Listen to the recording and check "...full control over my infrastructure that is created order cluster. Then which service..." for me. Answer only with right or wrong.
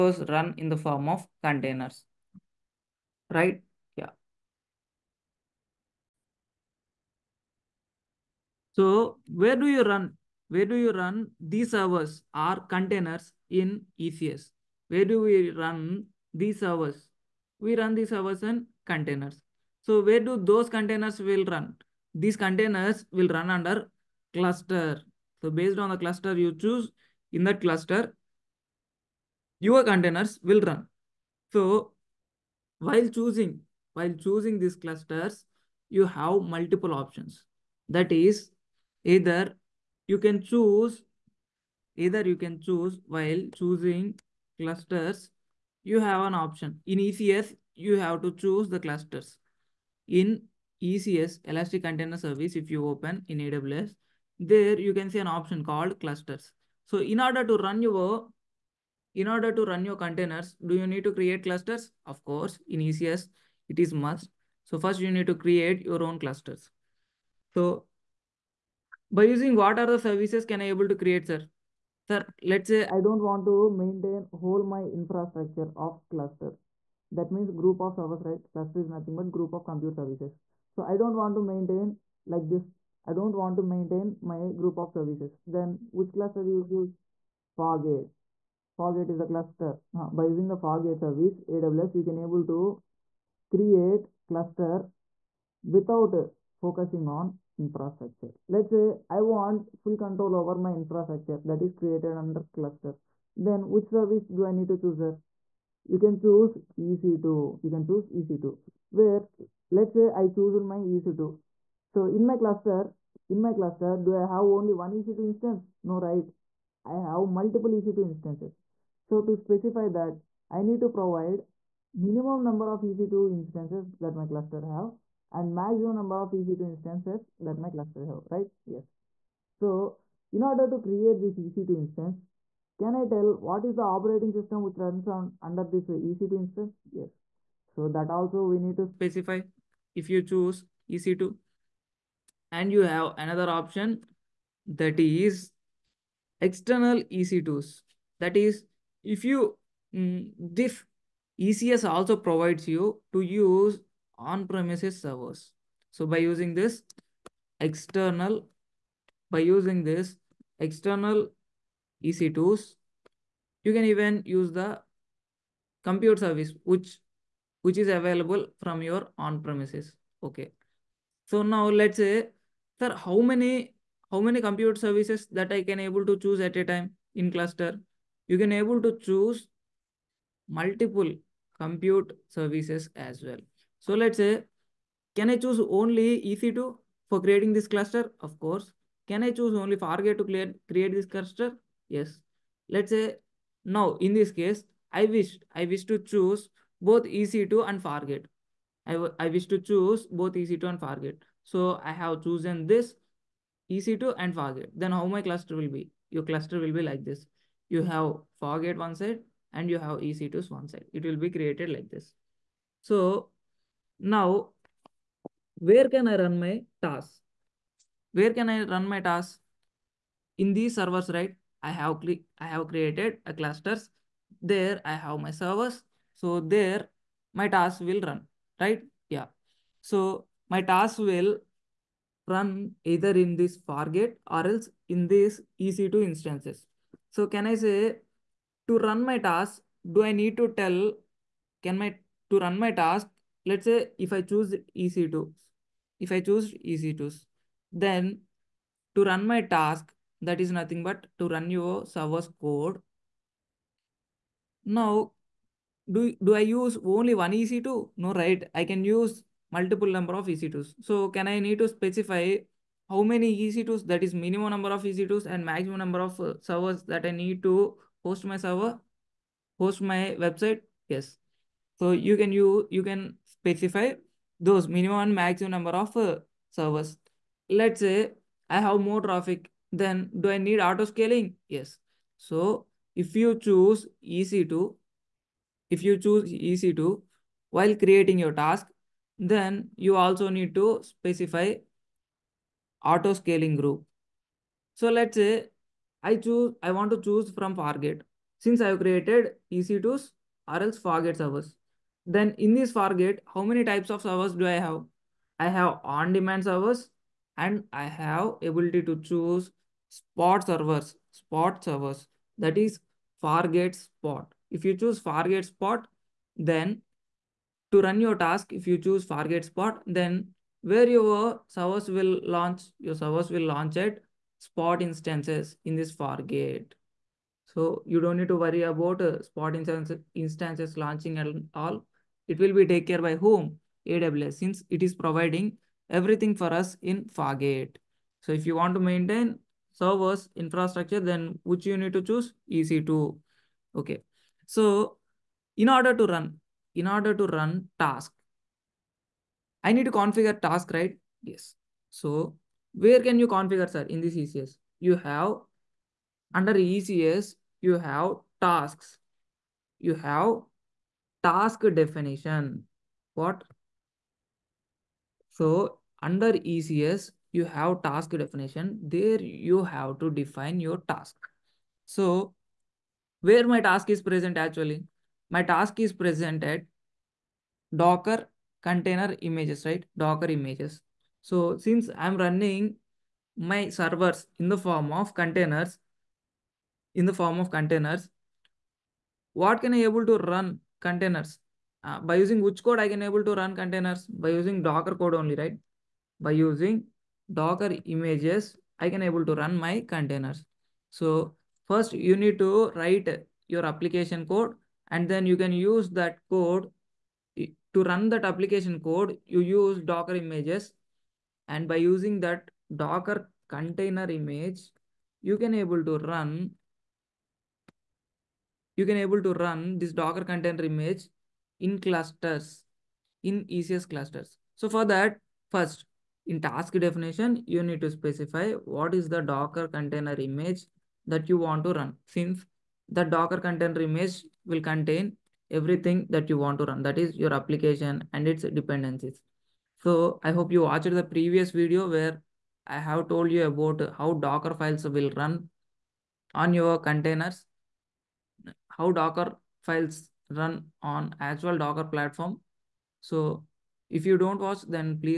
wrong.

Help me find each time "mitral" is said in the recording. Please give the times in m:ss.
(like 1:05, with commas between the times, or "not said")
not said.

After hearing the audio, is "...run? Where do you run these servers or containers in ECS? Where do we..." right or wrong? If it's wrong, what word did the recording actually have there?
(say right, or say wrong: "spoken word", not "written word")
right.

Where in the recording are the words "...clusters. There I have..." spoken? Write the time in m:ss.
3:43.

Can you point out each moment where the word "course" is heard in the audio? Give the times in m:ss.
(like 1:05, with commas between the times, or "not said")
1:02, 3:08.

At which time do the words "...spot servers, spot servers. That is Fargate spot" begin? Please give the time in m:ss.
5:09.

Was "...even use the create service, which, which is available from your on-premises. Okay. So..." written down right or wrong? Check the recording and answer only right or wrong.
wrong.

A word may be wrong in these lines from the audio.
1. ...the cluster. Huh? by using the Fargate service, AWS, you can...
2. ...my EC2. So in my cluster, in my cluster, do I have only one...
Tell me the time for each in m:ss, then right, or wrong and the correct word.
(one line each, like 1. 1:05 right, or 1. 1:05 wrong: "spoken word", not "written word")
1. 1:29 right
2. 1:50 right.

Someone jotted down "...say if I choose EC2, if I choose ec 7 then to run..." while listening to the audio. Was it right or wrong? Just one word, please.
wrong.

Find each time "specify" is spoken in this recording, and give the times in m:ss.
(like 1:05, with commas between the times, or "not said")
1:59, 2:18, 4:21, 4:33, 4:50, 7:07.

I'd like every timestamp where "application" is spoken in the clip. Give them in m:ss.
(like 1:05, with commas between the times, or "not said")
6:43, 6:48, 7:17.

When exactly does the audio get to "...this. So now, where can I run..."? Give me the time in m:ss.
3:31.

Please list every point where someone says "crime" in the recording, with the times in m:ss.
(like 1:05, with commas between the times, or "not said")
not said.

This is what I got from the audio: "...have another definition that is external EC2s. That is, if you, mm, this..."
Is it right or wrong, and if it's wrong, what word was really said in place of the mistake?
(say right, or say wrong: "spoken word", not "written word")
wrong: "option", not "definition".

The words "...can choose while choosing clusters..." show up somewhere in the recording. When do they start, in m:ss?
0:42.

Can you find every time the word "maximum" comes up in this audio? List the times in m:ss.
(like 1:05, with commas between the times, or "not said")
2:05, 4:25, 4:35.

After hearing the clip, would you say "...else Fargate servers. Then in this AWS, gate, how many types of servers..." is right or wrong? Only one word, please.
wrong.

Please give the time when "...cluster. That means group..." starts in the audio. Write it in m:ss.
1:16.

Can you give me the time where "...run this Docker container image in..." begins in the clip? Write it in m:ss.
6:59.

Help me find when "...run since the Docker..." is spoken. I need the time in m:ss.
7:11.